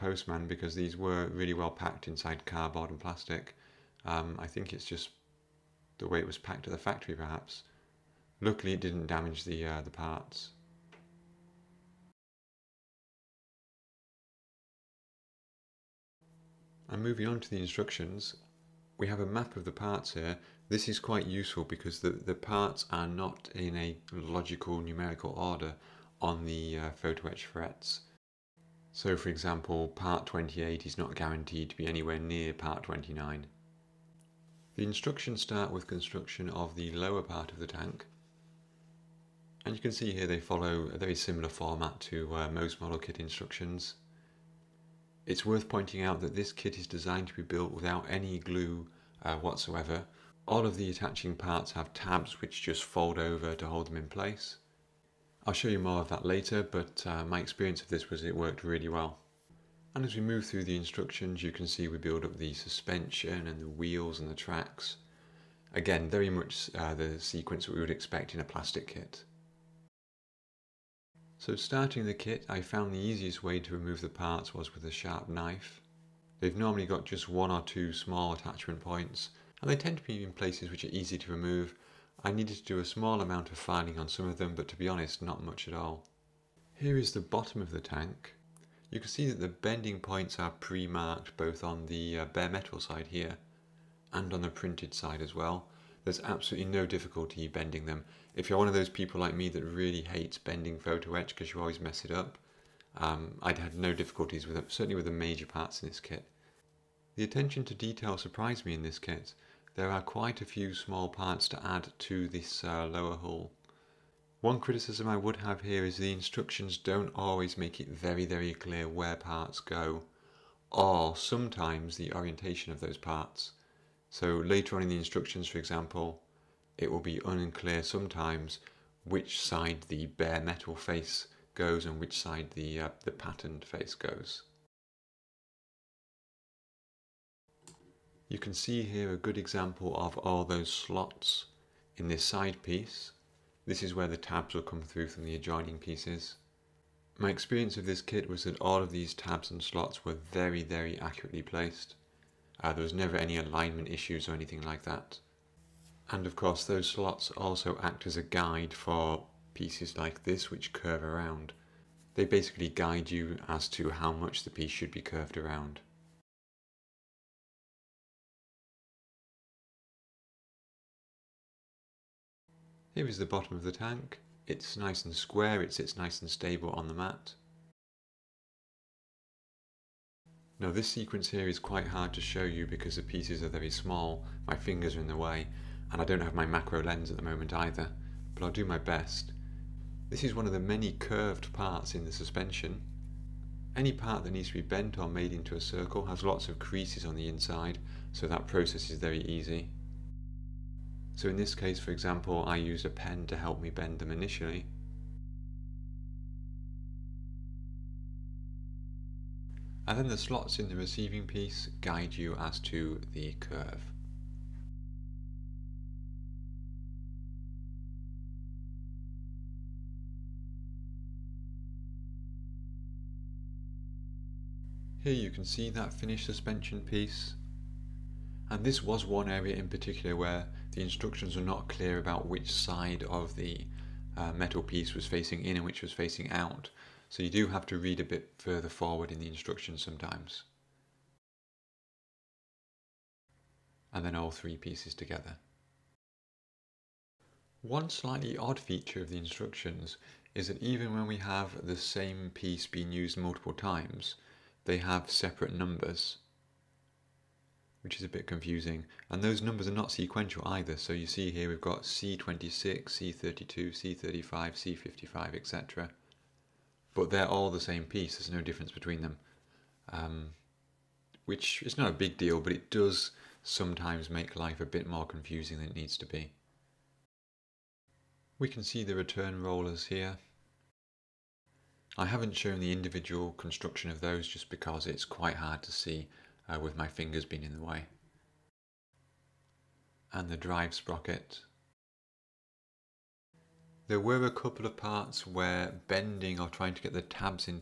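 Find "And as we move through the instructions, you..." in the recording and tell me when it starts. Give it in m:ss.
0:59.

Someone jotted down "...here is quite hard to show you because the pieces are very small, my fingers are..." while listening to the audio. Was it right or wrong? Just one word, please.
right.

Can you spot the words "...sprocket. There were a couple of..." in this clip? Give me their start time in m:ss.
4:50.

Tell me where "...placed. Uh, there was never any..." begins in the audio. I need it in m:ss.
2:31.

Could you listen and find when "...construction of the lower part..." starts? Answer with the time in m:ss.
0:35.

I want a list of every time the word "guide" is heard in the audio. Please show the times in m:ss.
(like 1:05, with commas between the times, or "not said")
2:38, 2:42, 3:31.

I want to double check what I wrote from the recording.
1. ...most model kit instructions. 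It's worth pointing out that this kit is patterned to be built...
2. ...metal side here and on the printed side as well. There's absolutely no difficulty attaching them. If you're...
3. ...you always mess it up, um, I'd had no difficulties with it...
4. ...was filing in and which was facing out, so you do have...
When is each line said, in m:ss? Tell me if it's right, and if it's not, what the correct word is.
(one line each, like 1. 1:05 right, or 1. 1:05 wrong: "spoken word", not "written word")
1. 0:42 wrong: "designed", not "patterned"
2. 1:32 wrong: "bending", not "attaching"
3. 1:41 right
4. 3:54 wrong: "facing", not "filing".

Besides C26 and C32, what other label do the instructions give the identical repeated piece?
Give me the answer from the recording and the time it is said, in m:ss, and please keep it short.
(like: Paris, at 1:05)
C35, at 4:23.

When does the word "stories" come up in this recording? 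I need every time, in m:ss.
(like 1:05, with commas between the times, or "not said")
not said.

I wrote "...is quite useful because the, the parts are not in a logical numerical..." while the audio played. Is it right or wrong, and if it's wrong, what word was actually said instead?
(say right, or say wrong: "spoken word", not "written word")
right.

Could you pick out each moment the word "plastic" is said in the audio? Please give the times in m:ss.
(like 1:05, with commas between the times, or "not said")
0:03, 1:08.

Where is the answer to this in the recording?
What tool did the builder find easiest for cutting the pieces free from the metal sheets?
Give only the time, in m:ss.
1:14.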